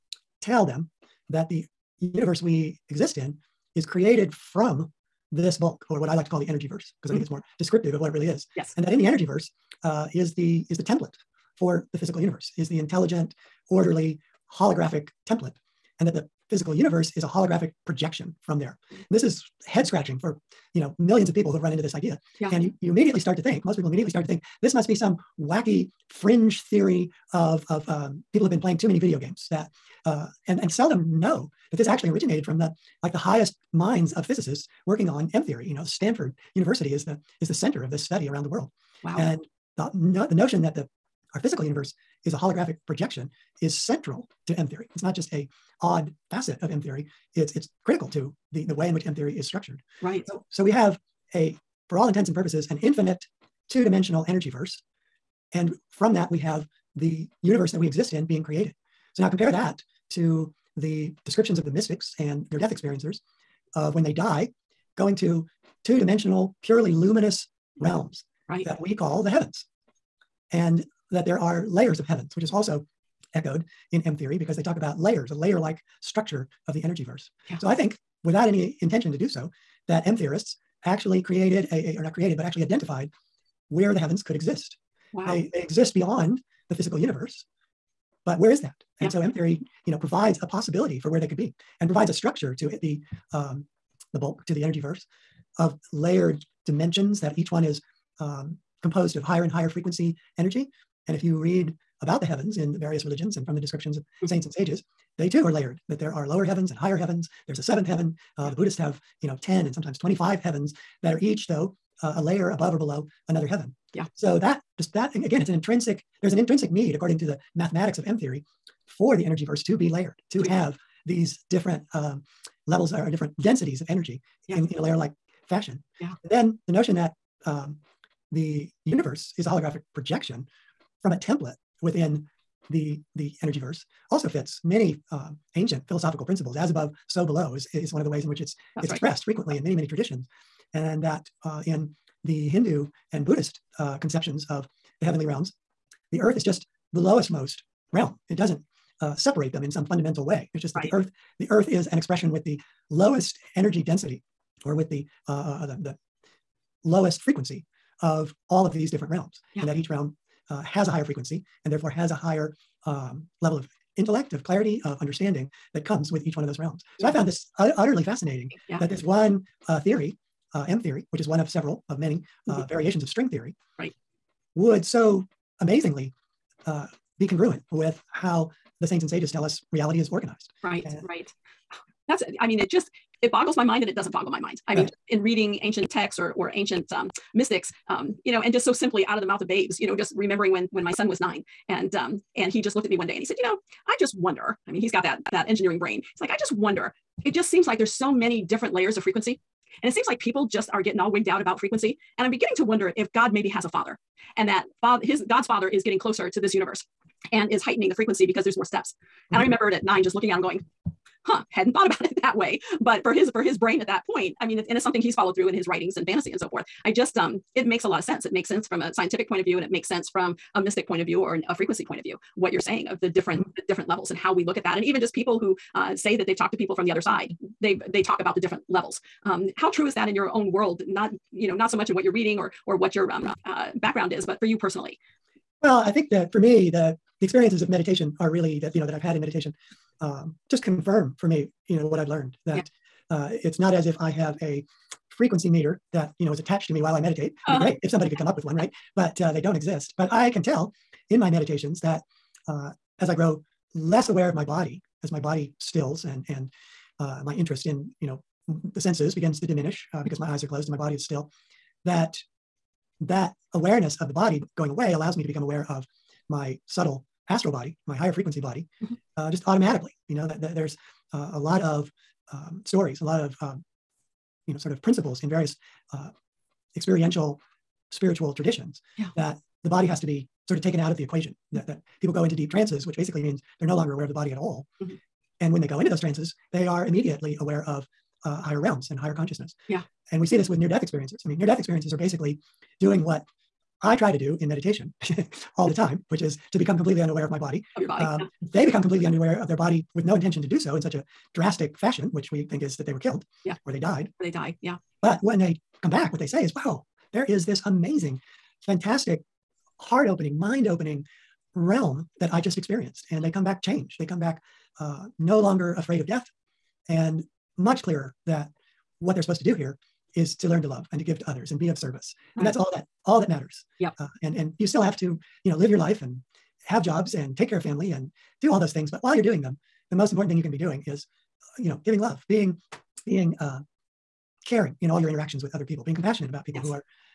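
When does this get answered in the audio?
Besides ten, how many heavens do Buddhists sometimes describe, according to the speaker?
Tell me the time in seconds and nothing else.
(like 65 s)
109 s.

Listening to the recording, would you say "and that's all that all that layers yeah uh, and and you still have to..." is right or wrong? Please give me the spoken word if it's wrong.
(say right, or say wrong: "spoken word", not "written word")
wrong: "matters", not "layers".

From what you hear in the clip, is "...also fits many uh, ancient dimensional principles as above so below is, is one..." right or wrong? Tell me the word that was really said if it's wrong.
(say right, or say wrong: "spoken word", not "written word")
wrong: "philosophical", not "dimensional".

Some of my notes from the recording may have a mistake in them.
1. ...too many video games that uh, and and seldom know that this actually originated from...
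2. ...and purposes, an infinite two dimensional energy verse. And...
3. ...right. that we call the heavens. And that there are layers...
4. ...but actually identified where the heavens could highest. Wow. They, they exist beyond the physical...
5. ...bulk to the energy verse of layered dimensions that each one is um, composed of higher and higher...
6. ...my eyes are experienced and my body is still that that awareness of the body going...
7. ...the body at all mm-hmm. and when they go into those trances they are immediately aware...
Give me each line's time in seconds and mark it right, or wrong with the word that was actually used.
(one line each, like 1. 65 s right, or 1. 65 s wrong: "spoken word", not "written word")
1. 28 s right
2. 52 s right
3. 68 s right
4. 82 s wrong: "exist", not "highest"
5. 94 s right
6. 260 s wrong: "closed", not "experienced"
7. 284 s right.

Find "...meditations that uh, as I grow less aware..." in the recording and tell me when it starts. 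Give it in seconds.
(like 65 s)
251 s.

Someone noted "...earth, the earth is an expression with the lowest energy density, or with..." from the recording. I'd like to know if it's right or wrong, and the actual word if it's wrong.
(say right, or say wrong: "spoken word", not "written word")
right.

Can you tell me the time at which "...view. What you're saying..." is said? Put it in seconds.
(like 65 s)
222 s.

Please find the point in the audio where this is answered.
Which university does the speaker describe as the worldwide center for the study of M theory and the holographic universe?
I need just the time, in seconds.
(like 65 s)
35 s.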